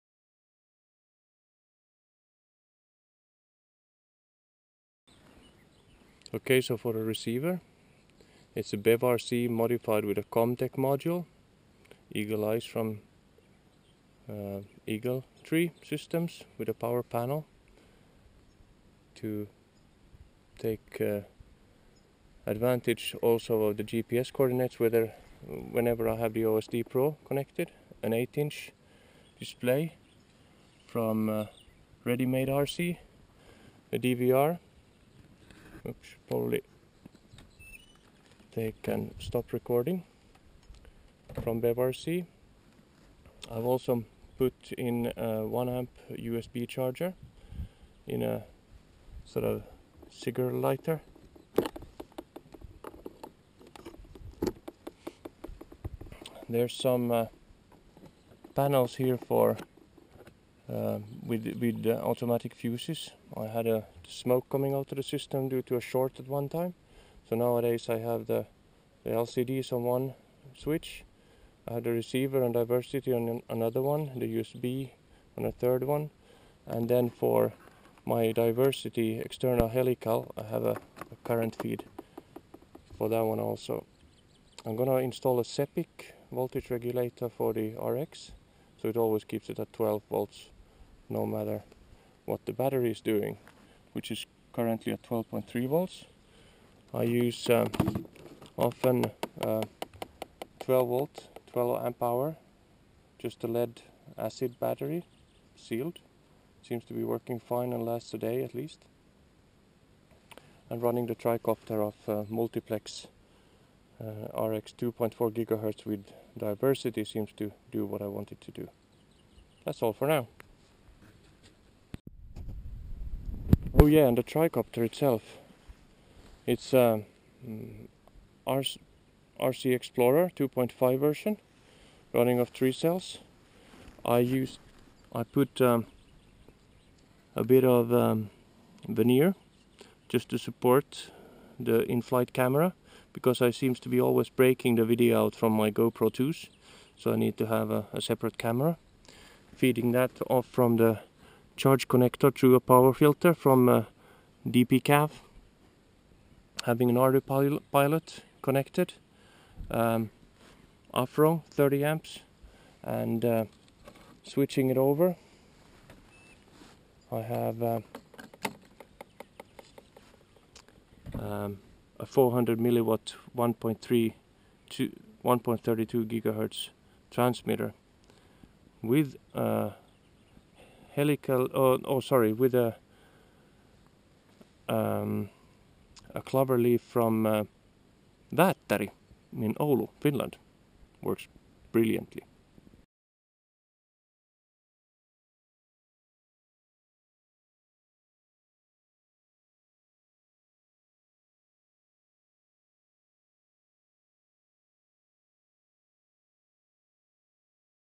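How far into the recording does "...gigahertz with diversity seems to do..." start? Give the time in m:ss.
1:55.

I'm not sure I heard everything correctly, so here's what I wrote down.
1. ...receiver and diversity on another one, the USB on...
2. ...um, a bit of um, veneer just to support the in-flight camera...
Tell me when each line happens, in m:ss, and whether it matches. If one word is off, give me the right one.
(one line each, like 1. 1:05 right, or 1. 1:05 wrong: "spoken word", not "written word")
1. 1:11 right
2. 2:15 right.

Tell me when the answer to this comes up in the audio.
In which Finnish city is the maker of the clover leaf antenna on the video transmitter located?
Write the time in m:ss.
3:09.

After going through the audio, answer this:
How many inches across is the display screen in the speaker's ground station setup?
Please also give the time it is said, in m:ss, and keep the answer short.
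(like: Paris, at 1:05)
8 inch, at 0:28.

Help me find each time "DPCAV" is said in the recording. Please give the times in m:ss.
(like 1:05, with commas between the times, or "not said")
2:34.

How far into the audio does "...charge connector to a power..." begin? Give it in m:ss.
2:31.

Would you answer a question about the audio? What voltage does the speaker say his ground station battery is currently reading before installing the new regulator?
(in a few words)
12.3 volts.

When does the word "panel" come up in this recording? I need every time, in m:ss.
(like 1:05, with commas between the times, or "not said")
0:17, 0:58.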